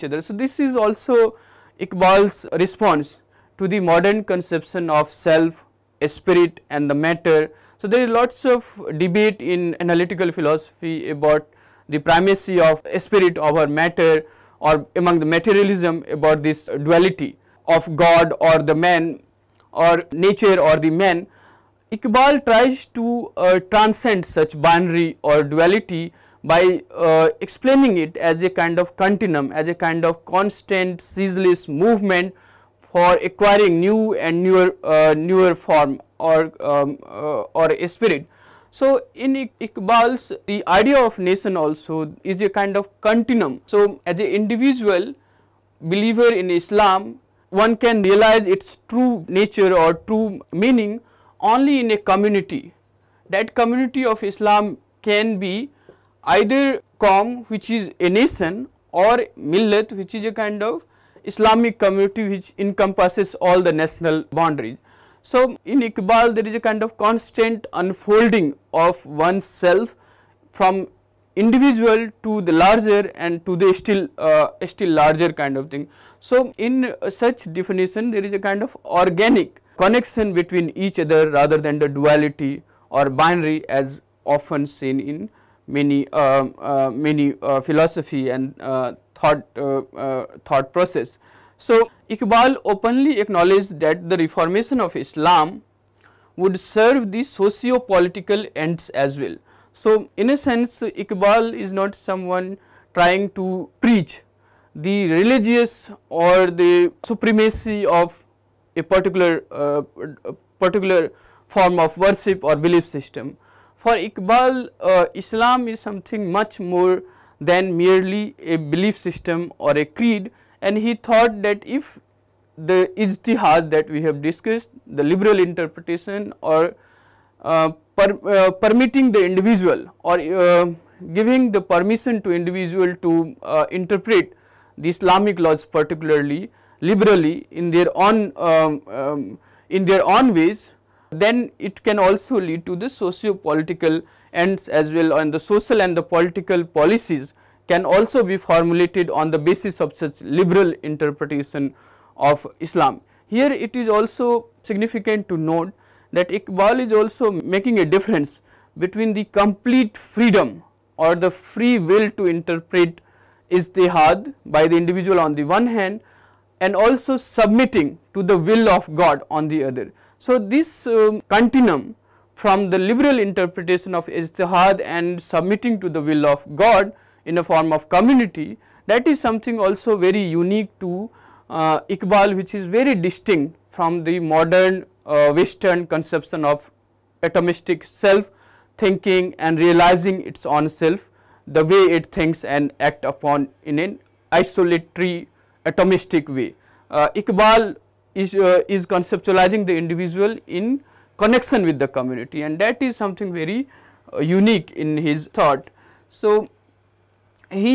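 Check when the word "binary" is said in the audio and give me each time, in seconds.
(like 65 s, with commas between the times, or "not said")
24 s, 83 s.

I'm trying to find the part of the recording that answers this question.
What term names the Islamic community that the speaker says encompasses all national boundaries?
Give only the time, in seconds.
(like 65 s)
59 s.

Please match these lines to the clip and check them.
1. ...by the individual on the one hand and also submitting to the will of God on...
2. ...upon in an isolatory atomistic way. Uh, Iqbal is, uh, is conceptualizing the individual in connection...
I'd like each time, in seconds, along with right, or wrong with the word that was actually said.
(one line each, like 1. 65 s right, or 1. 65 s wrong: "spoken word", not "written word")
1. 164 s right
2. 193 s right.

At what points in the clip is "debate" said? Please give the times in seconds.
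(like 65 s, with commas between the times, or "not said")
8 s.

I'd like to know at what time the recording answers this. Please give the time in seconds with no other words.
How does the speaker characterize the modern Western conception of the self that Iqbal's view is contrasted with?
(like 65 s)
187 s.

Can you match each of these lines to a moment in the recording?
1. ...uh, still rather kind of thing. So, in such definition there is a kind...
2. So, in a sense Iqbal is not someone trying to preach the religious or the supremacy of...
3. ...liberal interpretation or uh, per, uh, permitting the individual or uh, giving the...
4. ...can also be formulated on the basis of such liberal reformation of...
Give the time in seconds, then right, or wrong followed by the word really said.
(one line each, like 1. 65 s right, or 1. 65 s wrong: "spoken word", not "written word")
1. 74 s wrong: "larger", not "rather"
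2. 99 s right
3. 125 s right
4. 147 s wrong: "interpretation", not "reformation".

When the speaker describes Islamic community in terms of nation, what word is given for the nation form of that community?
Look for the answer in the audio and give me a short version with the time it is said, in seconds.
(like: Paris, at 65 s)
Qom, at 56 s.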